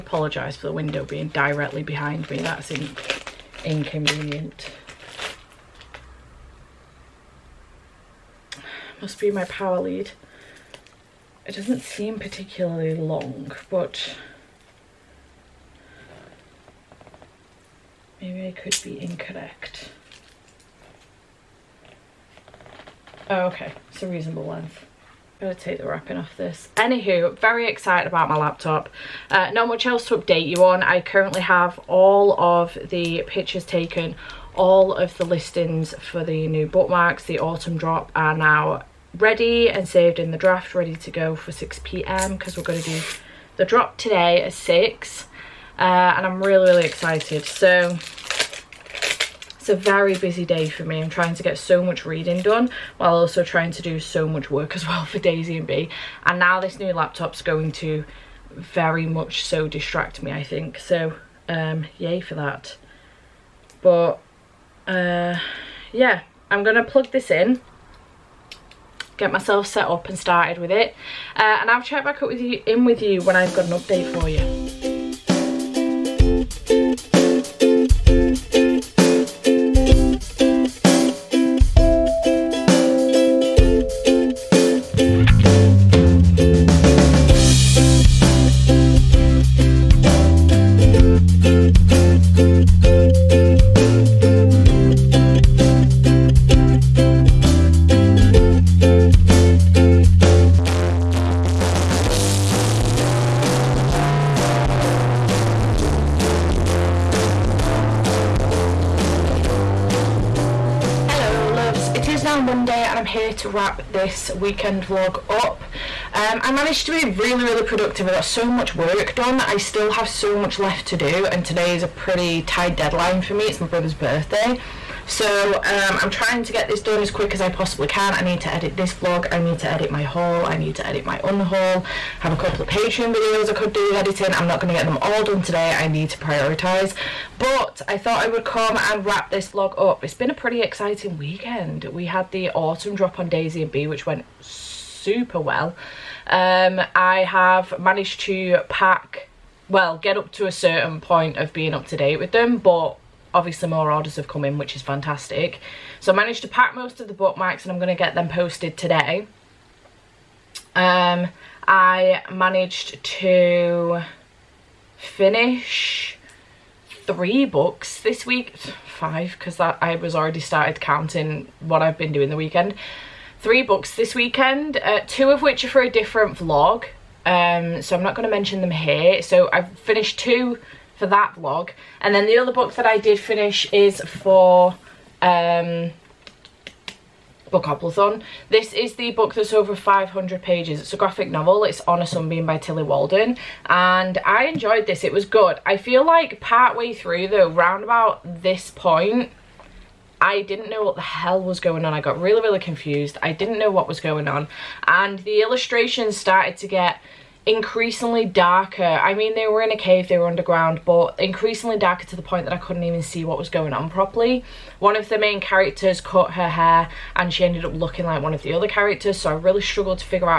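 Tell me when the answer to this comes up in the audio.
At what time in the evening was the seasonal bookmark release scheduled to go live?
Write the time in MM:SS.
00:41.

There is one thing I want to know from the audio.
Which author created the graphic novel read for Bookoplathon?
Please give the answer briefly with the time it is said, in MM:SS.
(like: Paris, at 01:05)
Tillie Walden, at 03:12.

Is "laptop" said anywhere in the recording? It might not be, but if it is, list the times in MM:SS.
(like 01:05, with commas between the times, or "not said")
00:28, 00:56.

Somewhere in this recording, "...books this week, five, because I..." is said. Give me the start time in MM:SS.
02:47.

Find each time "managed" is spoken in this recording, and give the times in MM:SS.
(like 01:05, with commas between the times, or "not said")
01:56, 02:27, 02:36, 02:42.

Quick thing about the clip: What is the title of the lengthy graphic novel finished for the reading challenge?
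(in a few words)
On a Sunbeam.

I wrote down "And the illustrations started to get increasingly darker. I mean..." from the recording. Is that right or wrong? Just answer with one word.
right.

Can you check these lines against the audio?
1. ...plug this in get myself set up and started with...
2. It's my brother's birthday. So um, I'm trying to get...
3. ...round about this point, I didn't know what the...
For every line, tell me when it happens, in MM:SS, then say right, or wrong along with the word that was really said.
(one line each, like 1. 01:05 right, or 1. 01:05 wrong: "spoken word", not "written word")
1. 01:06 right
2. 02:03 right
3. 03:17 right.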